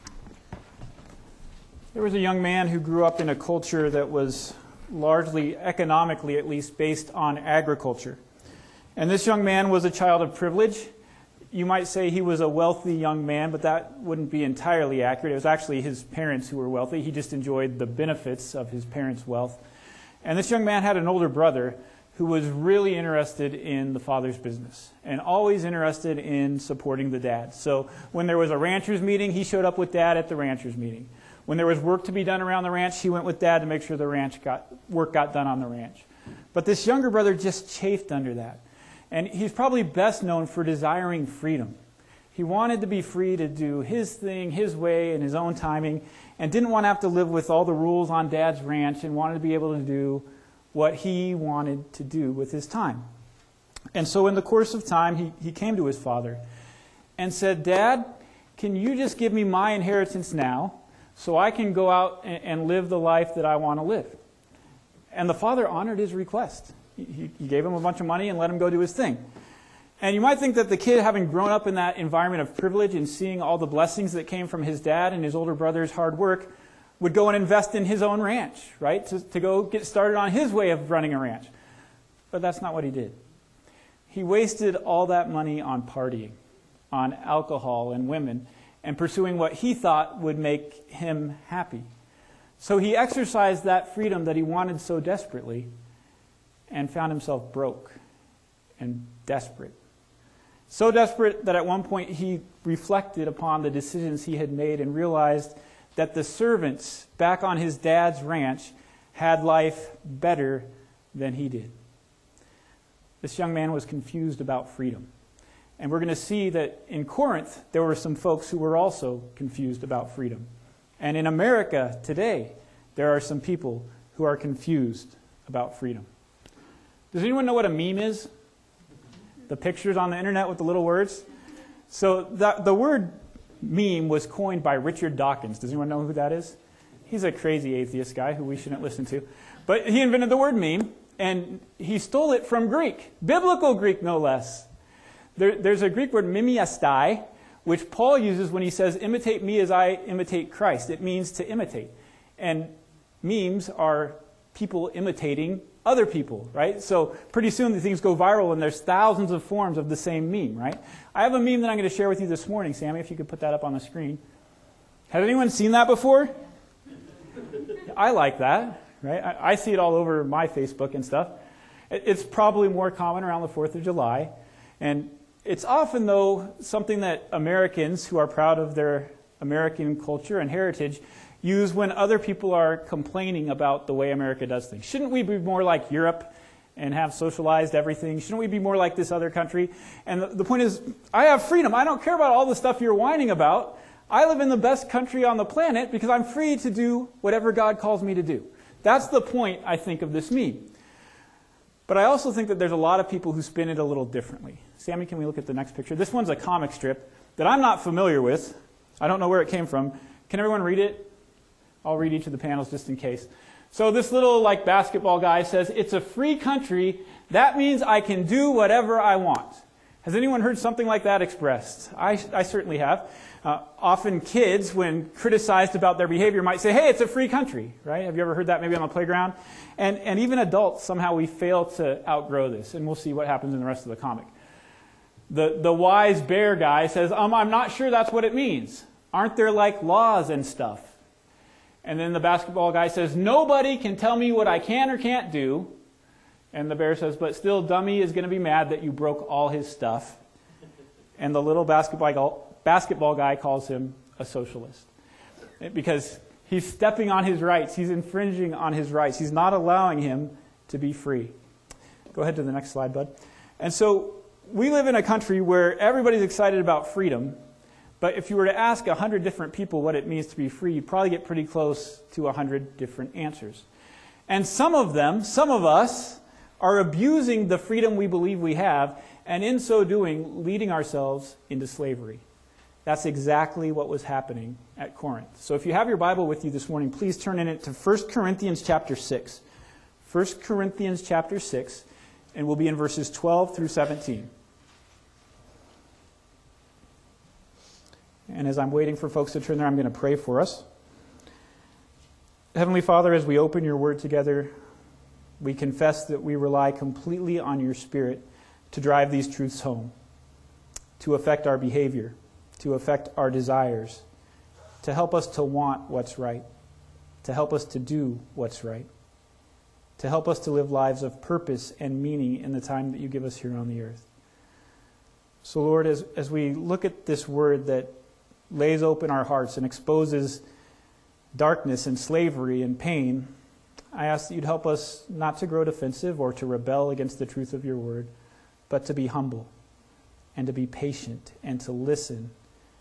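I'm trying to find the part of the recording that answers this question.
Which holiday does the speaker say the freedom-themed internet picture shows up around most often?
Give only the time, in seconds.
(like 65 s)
173 s.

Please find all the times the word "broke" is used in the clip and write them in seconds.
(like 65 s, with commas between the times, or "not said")
97 s, 248 s.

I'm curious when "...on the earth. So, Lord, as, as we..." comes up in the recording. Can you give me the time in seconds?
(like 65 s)
323 s.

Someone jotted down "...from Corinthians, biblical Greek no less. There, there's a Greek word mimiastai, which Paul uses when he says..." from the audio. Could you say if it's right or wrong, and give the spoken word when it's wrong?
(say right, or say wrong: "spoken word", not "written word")
wrong: "Greek", not "Corinthians".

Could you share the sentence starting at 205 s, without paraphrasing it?
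This one's a comic strip that I'm not familiar with.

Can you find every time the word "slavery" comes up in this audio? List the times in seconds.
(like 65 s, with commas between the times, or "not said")
281 s, 331 s.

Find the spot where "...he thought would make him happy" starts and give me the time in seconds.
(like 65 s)
89 s.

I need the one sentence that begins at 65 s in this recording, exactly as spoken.
And the father honored his request.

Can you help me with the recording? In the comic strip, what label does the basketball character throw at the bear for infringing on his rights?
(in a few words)
socialist.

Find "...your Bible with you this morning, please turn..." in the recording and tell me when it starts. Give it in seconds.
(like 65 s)
285 s.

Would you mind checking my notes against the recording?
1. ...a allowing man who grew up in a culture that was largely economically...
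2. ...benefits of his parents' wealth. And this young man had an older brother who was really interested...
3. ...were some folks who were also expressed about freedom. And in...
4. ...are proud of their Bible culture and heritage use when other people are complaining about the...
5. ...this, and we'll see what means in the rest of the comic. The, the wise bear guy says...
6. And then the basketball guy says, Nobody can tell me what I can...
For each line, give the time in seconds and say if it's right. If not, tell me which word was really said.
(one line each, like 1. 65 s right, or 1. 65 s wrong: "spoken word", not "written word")
1. 2 s wrong: "young", not "allowing"
2. 17 s right
3. 117 s wrong: "confused", not "expressed"
4. 178 s wrong: "American", not "Bible"
5. 232 s wrong: "happens", not "means"
6. 241 s right.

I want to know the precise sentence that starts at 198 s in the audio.
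That's the point, I think, of this meme.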